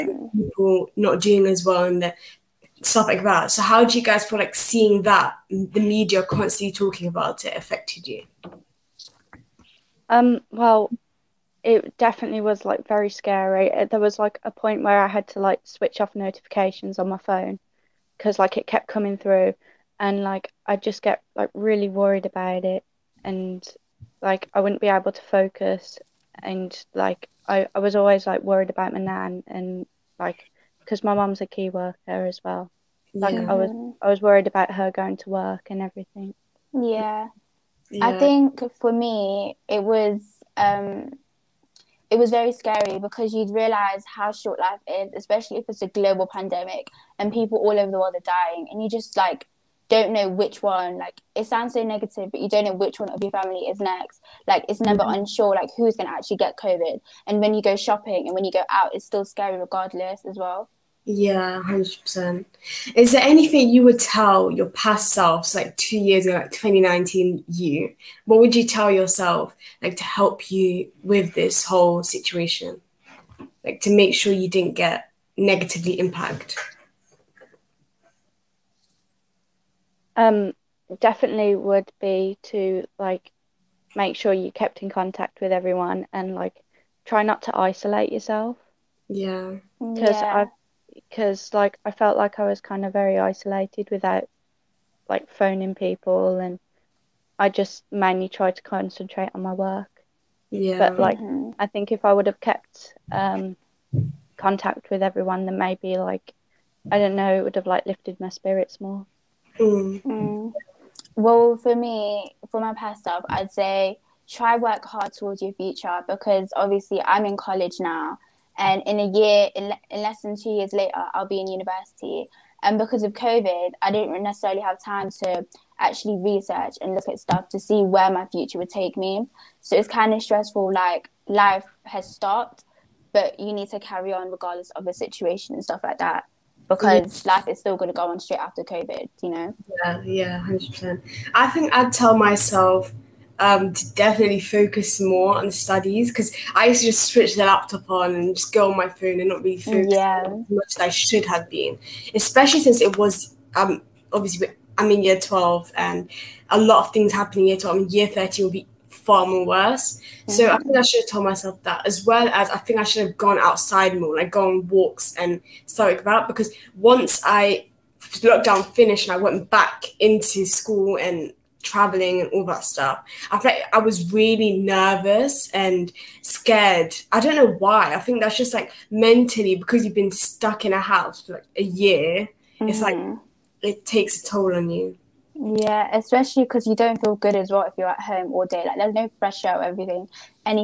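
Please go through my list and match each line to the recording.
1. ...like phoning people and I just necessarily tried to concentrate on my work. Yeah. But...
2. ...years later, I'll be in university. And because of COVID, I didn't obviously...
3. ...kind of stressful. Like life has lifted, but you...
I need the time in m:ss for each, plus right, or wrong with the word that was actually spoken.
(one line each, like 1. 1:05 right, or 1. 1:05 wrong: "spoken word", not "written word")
1. 1:35 wrong: "mainly", not "necessarily"
2. 2:00 wrong: "necessarily", not "obviously"
3. 2:09 wrong: "stopped", not "lifted".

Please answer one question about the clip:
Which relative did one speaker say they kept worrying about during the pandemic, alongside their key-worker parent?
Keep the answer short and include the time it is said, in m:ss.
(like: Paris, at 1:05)
Nan, at 0:28.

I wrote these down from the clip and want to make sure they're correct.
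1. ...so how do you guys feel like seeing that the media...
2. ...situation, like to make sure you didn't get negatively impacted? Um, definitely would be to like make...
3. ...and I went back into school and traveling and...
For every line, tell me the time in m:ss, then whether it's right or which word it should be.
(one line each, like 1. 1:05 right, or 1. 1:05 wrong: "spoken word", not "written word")
1. 0:03 right
2. 1:12 right
3. 2:49 right.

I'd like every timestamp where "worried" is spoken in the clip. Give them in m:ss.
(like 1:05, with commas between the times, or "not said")
0:21, 0:28, 0:34.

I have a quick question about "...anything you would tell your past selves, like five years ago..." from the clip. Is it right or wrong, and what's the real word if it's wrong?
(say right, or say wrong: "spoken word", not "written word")
wrong: "two", not "five".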